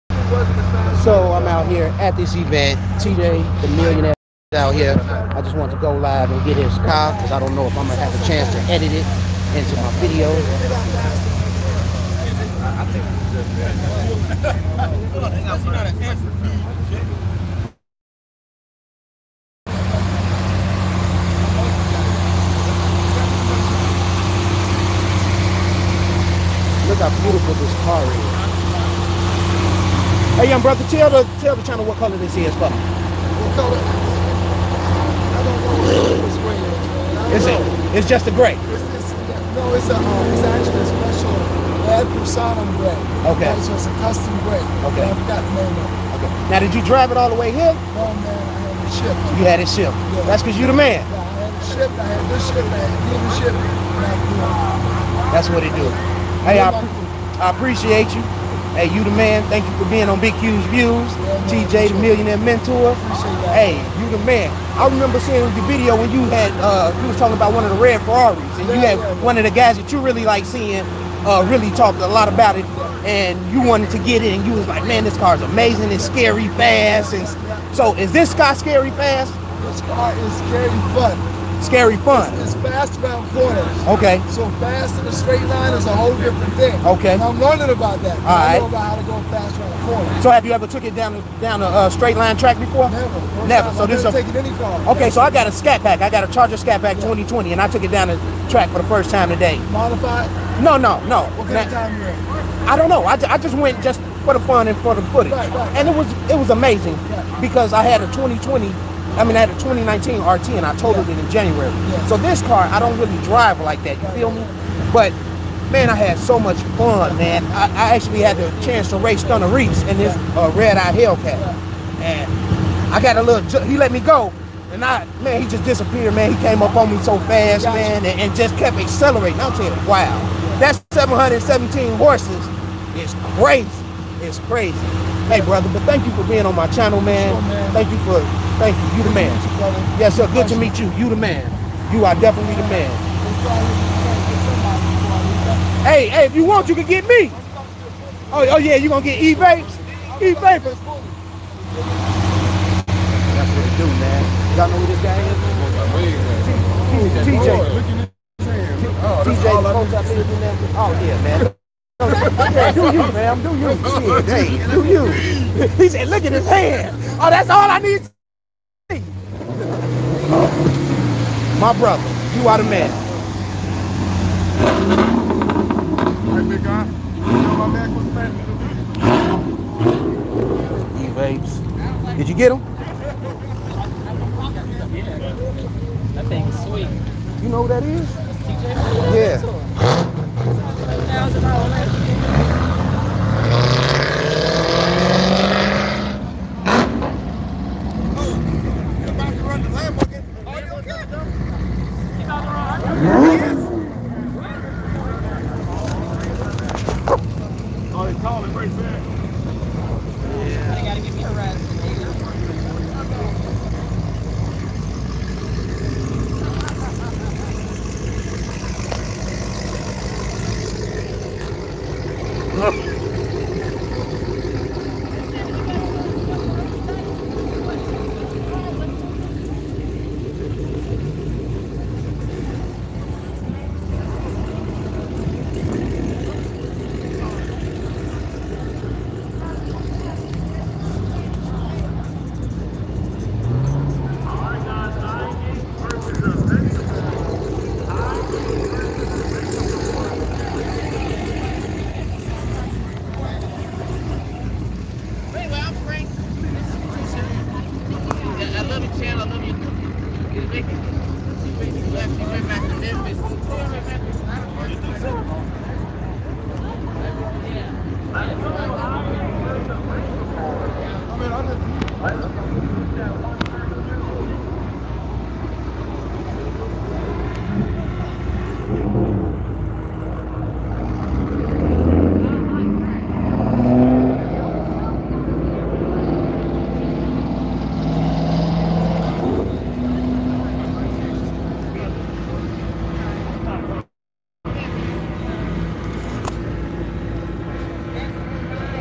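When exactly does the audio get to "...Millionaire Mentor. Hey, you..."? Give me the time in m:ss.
1:01.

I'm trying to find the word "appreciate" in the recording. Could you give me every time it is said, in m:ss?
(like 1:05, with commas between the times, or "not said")
0:57.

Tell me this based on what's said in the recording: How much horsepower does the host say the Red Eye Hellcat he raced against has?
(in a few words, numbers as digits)
717.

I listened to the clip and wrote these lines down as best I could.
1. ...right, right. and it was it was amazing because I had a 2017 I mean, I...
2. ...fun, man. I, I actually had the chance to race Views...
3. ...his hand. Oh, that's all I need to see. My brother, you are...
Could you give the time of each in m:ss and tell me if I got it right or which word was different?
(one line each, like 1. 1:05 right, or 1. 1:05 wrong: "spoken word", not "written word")
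1. 1:45 wrong: "2020", not "2017"
2. 1:56 wrong: "Stunna", not "Views"
3. 2:46 right.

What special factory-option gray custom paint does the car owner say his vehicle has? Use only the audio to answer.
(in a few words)
Ad Personam gray.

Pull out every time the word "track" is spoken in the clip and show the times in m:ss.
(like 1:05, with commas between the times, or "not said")
1:32, 1:38.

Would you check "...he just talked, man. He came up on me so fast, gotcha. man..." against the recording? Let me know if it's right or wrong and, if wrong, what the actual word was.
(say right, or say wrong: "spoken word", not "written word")
wrong: "disappeared", not "talked".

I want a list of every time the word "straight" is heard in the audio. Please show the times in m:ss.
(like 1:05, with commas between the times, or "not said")
1:25, 1:31.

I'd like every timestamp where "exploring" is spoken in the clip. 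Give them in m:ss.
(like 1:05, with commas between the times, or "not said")
not said.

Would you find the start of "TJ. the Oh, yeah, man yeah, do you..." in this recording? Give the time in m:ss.
2:39.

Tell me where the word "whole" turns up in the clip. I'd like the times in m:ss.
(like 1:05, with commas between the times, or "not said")
1:25.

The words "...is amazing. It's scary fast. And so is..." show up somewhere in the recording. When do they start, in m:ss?
1:15.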